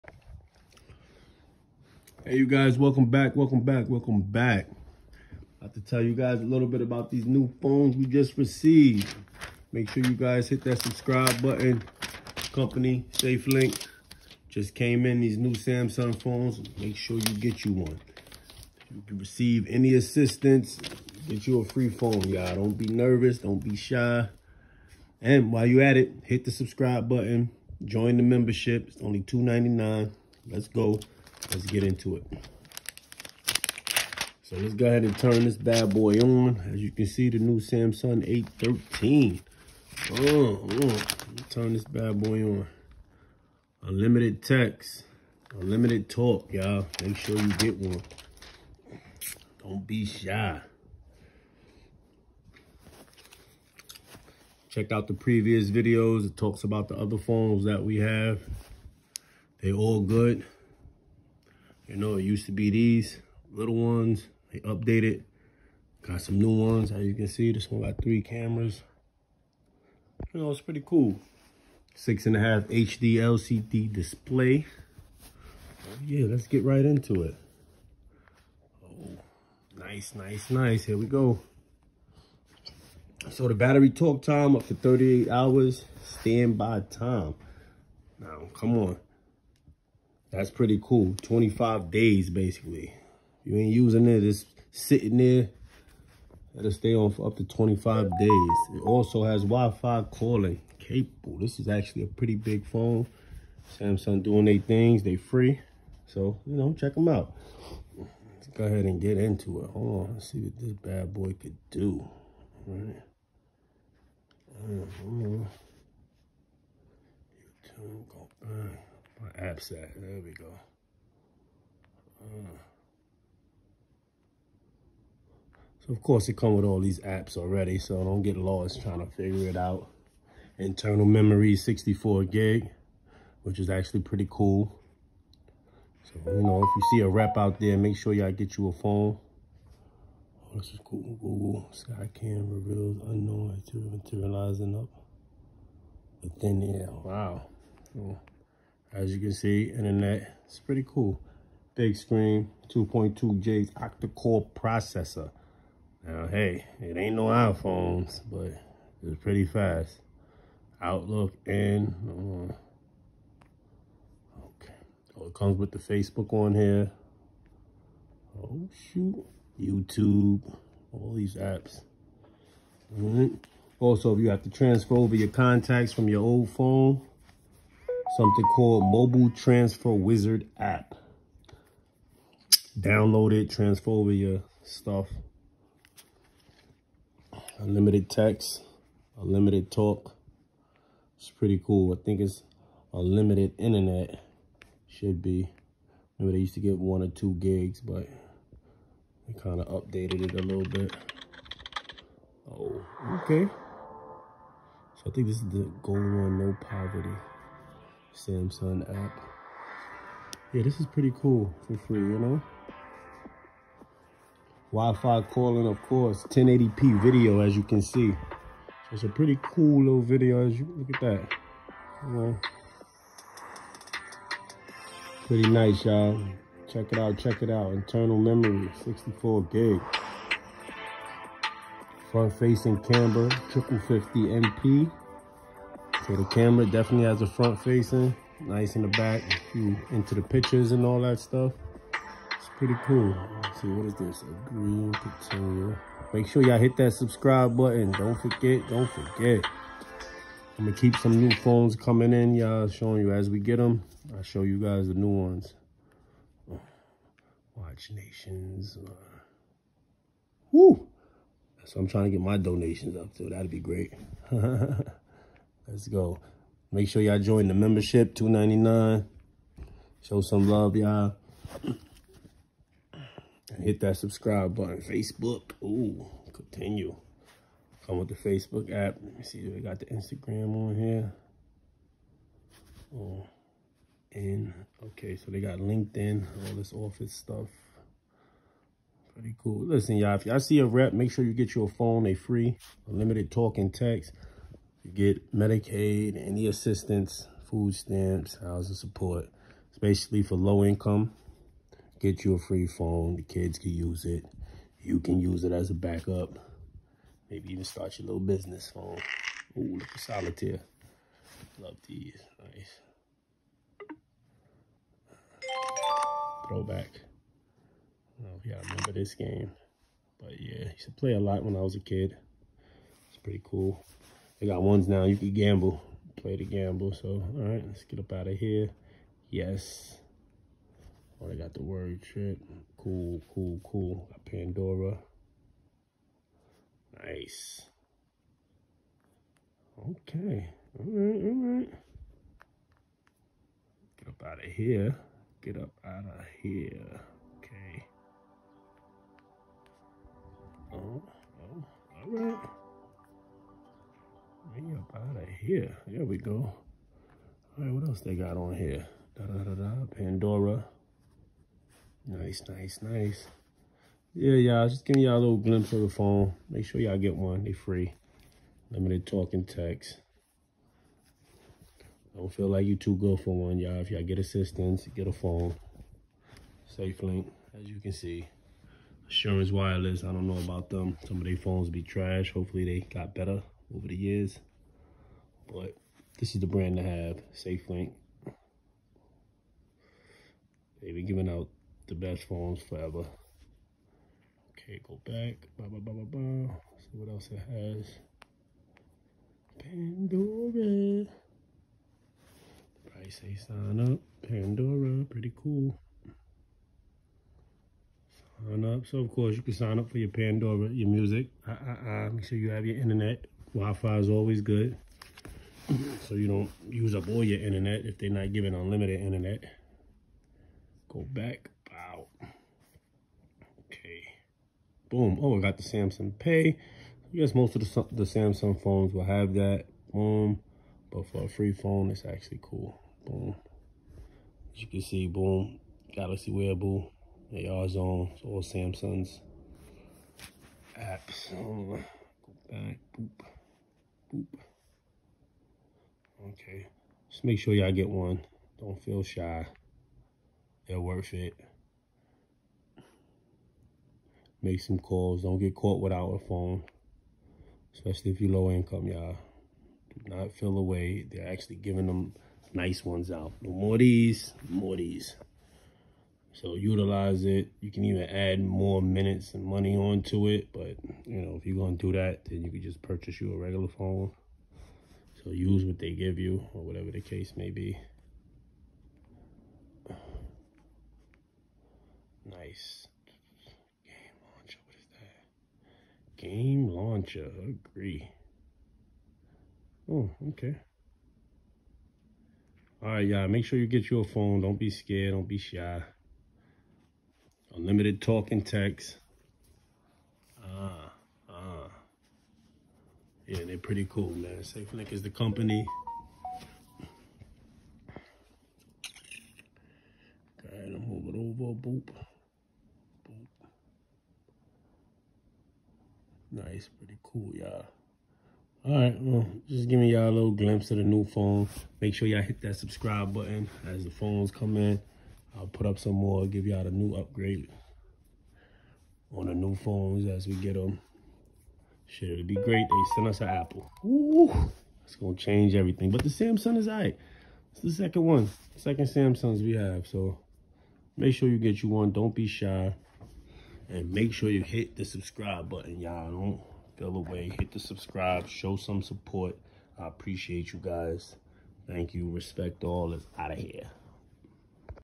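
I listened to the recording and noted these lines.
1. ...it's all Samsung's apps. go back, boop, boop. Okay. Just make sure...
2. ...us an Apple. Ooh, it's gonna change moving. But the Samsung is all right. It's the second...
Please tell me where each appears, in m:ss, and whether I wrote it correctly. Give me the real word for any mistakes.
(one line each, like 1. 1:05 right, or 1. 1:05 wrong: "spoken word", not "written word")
1. 7:18 right
2. 8:53 wrong: "everything", not "moving".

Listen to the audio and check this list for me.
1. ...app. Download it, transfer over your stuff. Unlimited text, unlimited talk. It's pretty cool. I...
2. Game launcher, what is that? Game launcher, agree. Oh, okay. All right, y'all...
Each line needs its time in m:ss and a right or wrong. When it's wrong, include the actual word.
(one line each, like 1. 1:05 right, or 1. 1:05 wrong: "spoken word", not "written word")
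1. 3:00 right
2. 8:03 right.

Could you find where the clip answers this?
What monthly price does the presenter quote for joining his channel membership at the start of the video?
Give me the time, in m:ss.
0:29.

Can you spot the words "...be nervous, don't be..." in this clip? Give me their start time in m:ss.
0:22.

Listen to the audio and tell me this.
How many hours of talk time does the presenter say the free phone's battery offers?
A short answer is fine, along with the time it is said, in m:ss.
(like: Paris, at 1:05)
38 hours, at 1:24.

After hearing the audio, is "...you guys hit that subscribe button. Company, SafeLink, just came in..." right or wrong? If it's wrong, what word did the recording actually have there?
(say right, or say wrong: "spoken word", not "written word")
right.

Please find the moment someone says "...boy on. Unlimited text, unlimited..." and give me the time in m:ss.
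0:42.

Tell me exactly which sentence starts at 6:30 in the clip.
They've been giving out the best phones forever.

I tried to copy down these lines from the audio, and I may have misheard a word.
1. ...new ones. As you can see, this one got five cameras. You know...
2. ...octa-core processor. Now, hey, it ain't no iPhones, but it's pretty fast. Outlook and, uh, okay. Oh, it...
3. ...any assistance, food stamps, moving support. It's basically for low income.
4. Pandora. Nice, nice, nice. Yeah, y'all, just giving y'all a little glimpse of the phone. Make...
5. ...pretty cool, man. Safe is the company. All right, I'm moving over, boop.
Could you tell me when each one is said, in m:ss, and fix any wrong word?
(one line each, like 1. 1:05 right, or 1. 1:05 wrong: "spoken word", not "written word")
1. 1:06 wrong: "three", not "five"
2. 2:33 right
3. 4:56 wrong: "housing", not "moving"
4. 5:59 right
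5. 8:23 right.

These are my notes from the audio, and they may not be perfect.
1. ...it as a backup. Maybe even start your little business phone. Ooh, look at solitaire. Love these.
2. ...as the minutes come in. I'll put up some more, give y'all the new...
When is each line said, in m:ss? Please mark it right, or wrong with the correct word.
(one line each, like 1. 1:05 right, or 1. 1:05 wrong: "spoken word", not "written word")
1. 5:05 right
2. 8:43 wrong: "phones", not "minutes".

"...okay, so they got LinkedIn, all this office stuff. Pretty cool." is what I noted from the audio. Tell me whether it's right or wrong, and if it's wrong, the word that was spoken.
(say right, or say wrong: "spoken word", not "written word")
right.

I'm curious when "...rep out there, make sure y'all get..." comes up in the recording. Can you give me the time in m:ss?
2:17.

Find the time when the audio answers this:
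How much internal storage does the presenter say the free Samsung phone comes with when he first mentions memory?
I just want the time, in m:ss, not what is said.
2:10.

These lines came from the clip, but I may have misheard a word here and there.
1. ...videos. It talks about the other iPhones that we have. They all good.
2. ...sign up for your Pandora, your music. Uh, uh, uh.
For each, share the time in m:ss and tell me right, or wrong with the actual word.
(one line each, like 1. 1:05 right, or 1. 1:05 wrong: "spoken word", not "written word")
1. 0:55 wrong: "phones", not "iPhones"
2. 6:49 right.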